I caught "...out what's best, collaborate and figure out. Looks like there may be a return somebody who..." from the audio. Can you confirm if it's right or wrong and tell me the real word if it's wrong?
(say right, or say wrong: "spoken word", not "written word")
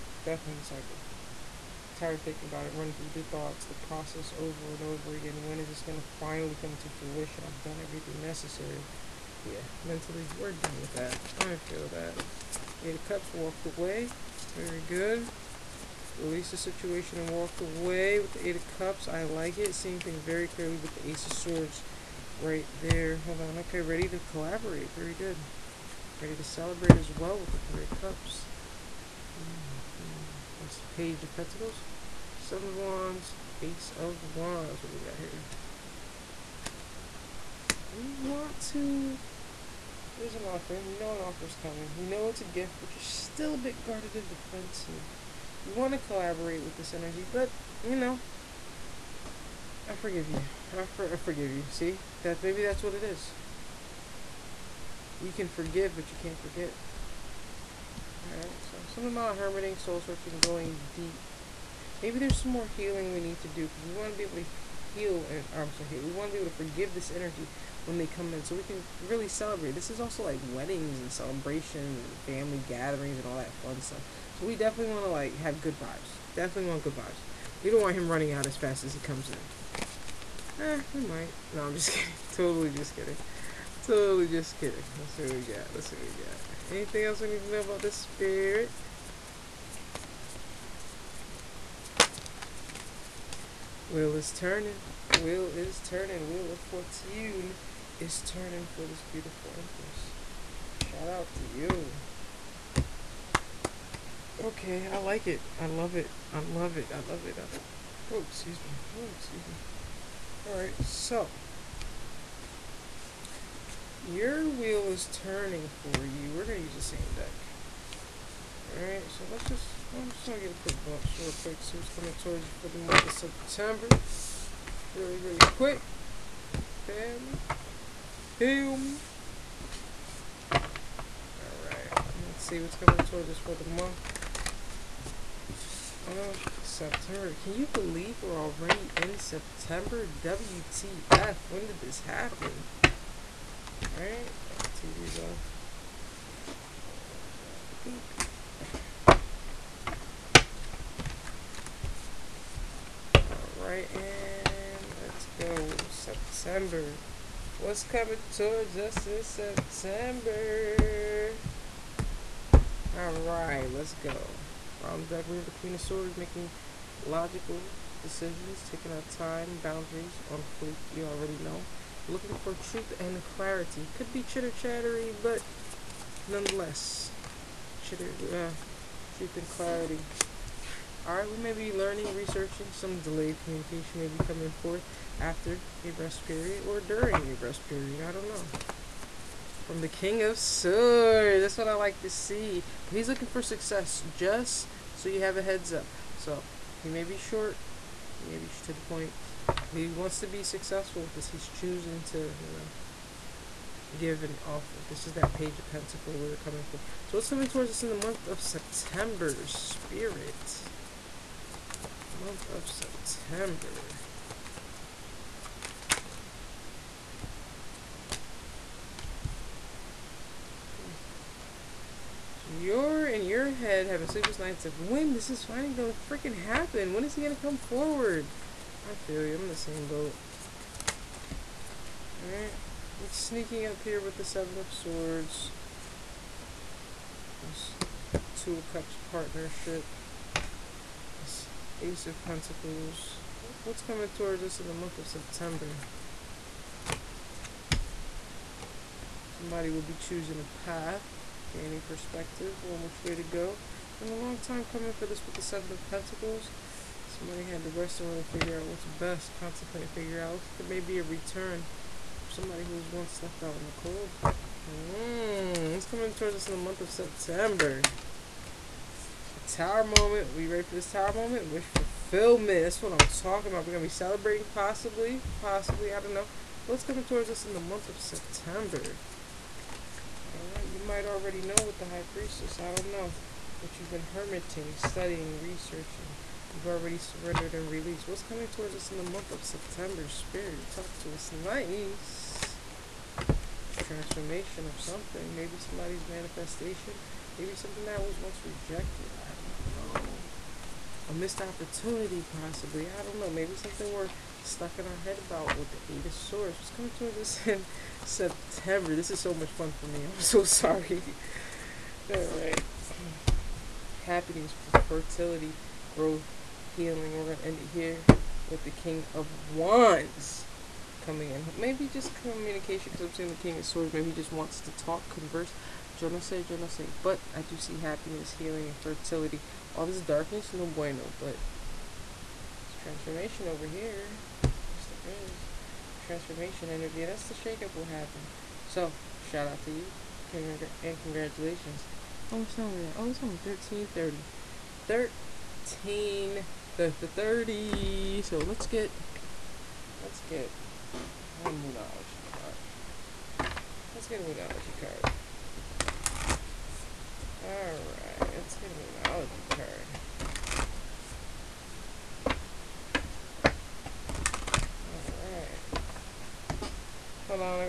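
wrong: "contemplate", not "collaborate".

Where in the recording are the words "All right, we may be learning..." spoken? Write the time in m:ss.
3:01.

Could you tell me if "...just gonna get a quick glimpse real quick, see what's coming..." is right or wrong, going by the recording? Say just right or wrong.
right.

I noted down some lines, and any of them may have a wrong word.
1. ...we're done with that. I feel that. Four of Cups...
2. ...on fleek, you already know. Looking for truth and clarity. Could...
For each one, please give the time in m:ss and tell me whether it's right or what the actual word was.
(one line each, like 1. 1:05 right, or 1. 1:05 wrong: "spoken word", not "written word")
1. 0:10 wrong: "Eight", not "Four"
2. 2:50 right.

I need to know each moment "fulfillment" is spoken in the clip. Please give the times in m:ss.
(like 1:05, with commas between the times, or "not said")
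4:31.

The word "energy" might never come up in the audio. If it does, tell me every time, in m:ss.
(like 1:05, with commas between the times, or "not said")
0:46, 1:07, 5:36.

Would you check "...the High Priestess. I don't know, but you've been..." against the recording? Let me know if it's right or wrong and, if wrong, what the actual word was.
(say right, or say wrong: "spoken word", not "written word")
right.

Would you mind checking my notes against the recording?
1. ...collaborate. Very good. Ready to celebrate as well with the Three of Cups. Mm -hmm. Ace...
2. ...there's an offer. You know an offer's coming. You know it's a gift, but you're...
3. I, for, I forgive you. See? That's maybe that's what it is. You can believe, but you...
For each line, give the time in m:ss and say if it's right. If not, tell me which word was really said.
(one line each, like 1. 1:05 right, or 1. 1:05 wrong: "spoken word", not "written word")
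1. 0:24 right
2. 0:40 right
3. 0:50 wrong: "forgive", not "believe".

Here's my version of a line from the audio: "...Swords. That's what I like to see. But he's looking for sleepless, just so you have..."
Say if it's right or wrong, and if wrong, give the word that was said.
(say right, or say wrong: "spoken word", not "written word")
wrong: "success", not "sleepless".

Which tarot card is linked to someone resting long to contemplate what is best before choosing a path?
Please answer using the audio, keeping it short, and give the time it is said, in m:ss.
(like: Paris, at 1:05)
Seven of Pentacles, at 4:15.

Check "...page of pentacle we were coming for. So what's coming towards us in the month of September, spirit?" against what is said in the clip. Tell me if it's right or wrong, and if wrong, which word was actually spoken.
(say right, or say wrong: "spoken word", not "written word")
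right.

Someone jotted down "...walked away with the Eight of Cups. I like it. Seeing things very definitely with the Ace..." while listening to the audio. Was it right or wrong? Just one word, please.
wrong.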